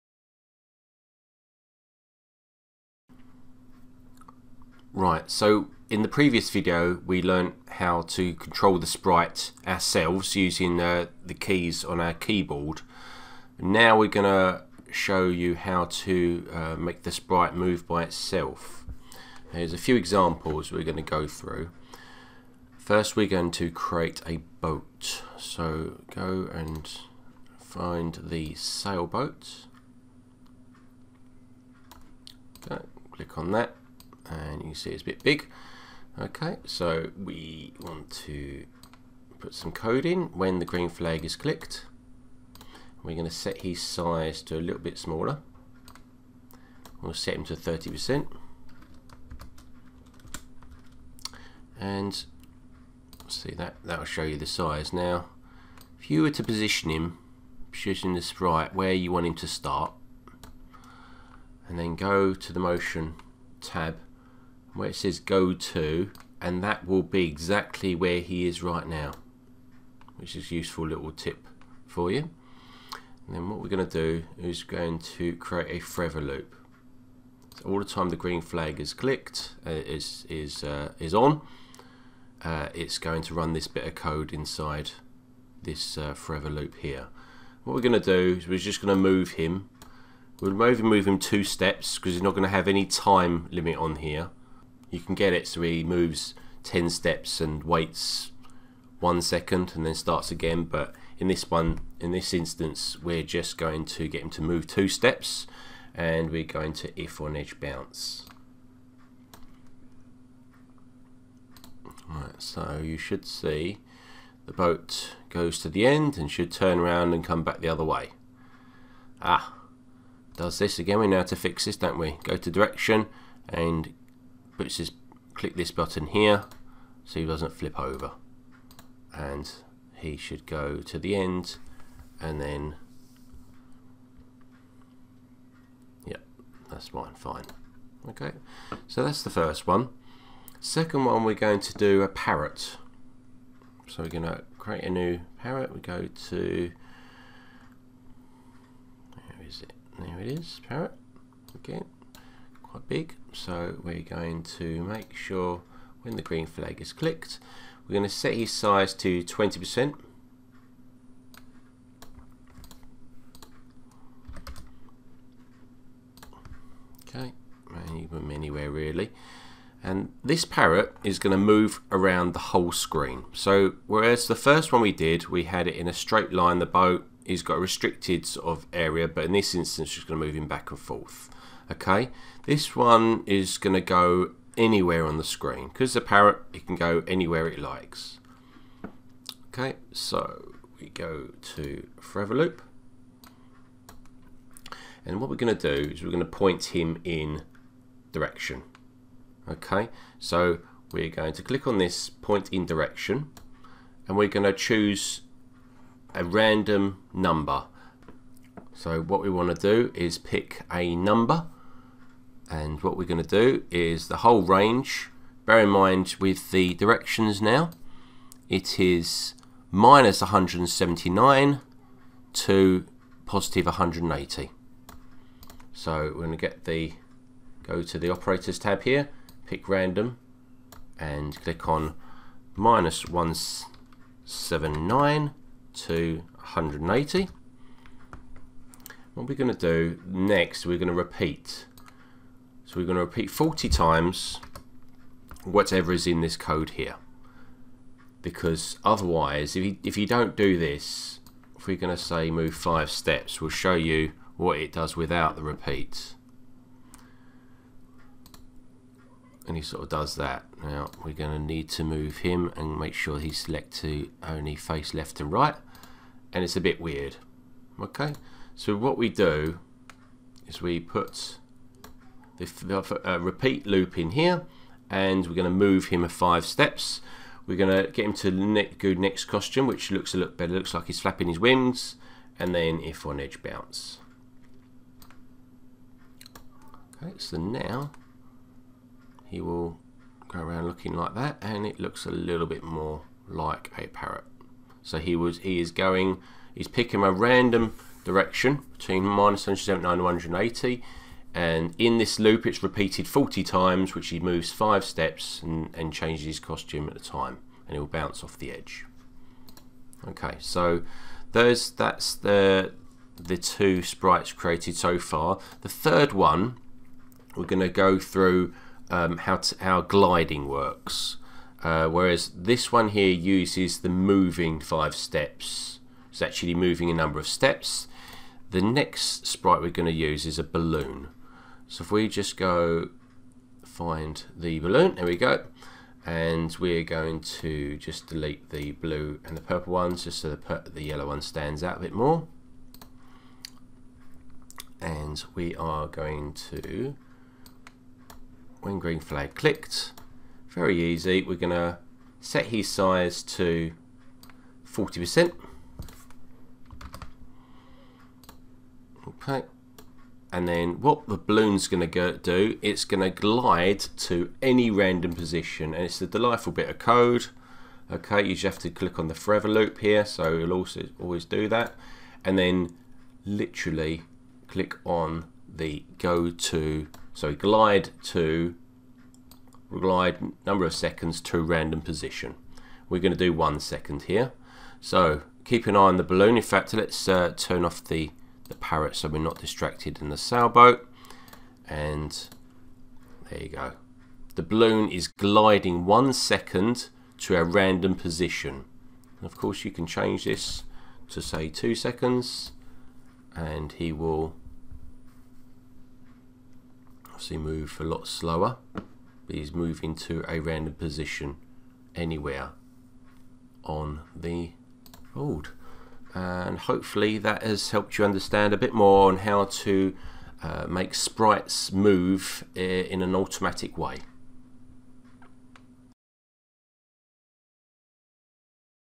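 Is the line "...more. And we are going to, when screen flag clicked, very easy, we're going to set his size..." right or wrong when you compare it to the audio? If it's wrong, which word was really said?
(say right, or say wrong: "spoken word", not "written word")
wrong: "green", not "screen".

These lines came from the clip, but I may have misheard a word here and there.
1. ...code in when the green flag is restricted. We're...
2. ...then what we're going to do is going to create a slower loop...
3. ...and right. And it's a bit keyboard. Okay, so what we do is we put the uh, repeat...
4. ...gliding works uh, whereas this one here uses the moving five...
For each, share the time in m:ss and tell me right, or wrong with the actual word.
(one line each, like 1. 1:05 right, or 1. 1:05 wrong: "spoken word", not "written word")
1. 0:39 wrong: "clicked", not "restricted"
2. 1:13 wrong: "forever", not "slower"
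3. 4:25 wrong: "weird", not "keyboard"
4. 5:19 right.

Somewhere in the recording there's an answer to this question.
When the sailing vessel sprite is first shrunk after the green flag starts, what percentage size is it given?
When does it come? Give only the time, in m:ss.
0:47.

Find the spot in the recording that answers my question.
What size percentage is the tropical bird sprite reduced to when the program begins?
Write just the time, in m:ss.
2:39.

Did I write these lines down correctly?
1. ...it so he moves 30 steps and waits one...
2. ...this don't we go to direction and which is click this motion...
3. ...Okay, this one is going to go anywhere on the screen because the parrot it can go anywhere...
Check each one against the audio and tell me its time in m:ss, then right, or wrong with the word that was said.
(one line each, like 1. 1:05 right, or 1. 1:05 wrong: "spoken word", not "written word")
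1. 1:35 wrong: "10", not "30"
2. 2:01 wrong: "button", not "motion"
3. 3:01 right.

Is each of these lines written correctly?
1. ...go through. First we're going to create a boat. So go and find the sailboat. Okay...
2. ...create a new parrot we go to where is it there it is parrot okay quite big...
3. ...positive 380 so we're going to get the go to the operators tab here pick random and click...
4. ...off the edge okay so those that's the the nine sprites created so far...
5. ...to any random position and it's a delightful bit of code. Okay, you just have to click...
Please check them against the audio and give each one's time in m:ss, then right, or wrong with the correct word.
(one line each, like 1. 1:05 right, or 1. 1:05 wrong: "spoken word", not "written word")
1. 0:21 right
2. 2:24 right
3. 3:43 wrong: "180", not "380"
4. 5:08 wrong: "two", not "nine"
5. 6:03 right.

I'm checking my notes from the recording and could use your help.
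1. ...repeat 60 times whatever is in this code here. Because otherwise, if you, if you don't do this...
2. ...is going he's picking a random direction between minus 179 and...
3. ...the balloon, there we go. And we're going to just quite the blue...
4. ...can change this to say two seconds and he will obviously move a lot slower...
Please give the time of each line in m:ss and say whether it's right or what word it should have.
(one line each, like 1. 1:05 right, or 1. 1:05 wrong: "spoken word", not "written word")
1. 4:03 wrong: "40", not "60"
2. 4:55 right
3. 5:34 wrong: "delete", not "quite"
4. 6:39 right.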